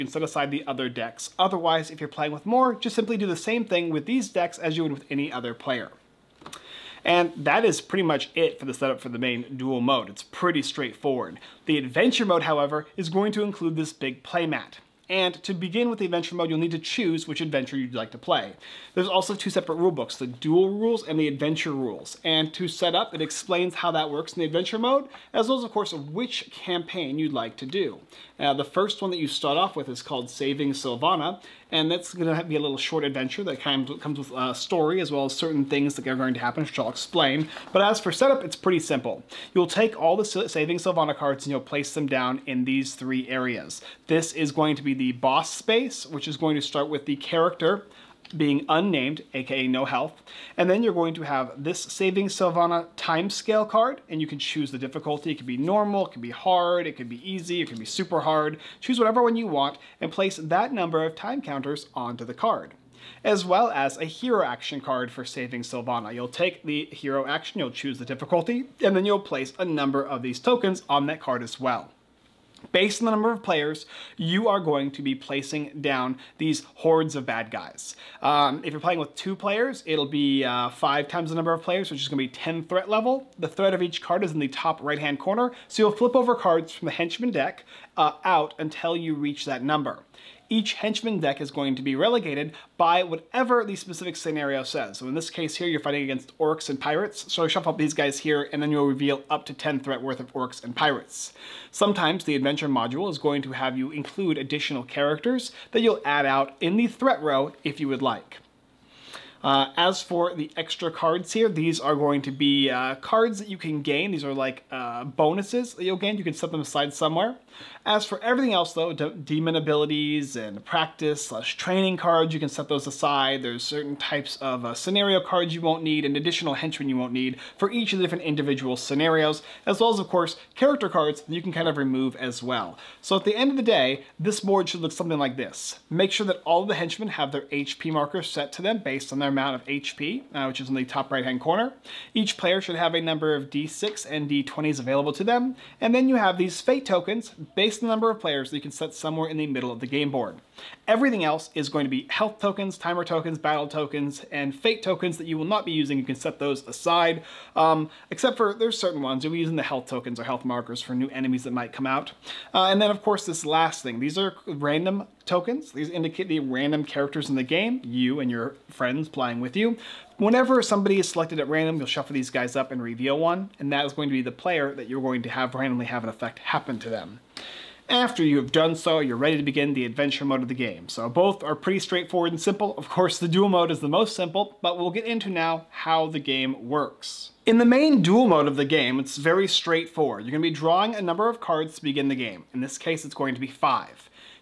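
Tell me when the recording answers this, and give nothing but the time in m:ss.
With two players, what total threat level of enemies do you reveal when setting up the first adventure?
1:22.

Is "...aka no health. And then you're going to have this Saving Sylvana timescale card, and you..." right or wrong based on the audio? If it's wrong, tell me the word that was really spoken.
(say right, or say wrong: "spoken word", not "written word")
right.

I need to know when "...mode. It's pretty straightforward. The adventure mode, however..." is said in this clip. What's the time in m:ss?
0:09.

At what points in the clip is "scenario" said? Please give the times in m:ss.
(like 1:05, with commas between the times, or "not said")
1:34, 2:04, 2:08.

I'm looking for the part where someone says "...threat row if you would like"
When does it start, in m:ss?
1:46.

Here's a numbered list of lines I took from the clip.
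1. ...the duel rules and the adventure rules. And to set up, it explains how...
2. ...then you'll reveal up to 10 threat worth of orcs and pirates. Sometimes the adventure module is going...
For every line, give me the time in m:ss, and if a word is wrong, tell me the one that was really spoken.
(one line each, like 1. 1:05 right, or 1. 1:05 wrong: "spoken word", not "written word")
1. 0:20 right
2. 1:38 right.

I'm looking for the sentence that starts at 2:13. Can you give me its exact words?
So at the end of the day, this board should look something like this.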